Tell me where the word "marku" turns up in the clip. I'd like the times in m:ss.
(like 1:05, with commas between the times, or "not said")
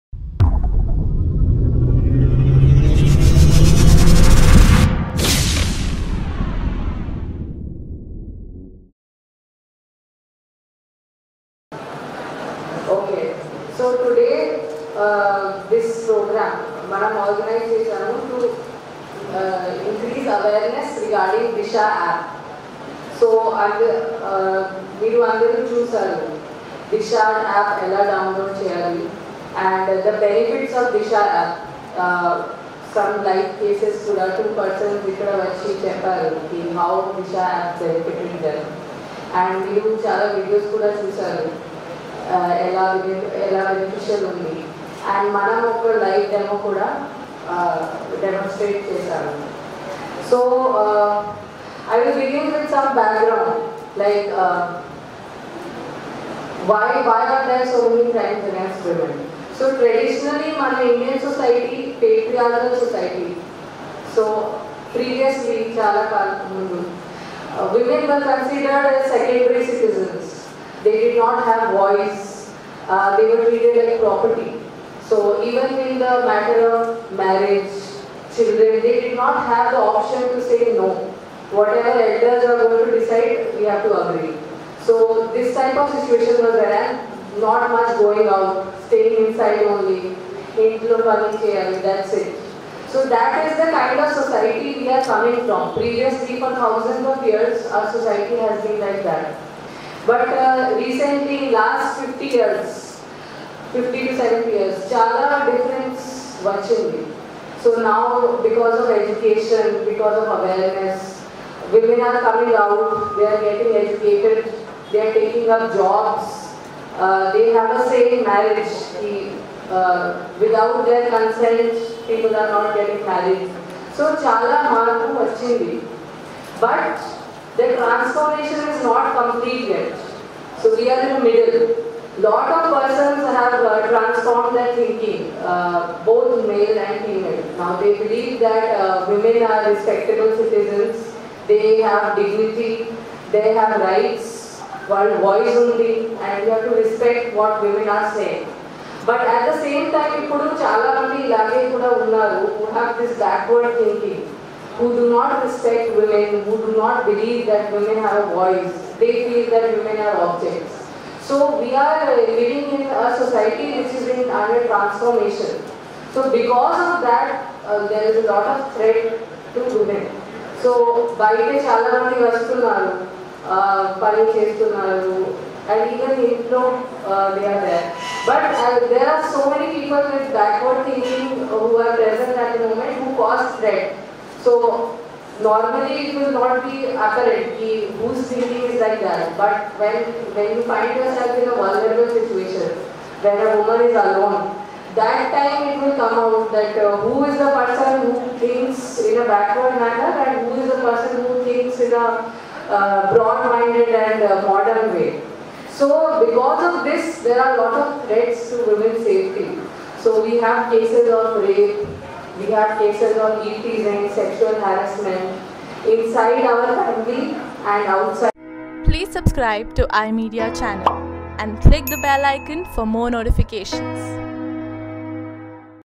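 2:04.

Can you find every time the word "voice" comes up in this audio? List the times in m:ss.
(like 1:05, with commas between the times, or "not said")
1:11, 2:25, 2:38.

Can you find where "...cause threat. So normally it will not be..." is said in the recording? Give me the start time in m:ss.
3:03.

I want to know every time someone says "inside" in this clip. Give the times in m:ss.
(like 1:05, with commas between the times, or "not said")
1:29, 3:35.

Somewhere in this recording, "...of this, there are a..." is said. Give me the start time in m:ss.
3:26.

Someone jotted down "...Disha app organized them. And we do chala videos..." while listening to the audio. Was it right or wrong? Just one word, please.
wrong.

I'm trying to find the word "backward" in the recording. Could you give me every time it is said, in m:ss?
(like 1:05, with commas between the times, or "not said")
2:33, 3:00, 3:19.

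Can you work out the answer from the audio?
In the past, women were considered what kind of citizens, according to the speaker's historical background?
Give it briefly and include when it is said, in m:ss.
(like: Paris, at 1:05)
Secondary citizens, at 1:09.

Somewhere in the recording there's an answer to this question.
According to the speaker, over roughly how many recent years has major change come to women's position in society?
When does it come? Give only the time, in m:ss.
1:43.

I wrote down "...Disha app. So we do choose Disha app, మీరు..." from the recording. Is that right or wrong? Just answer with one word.
right.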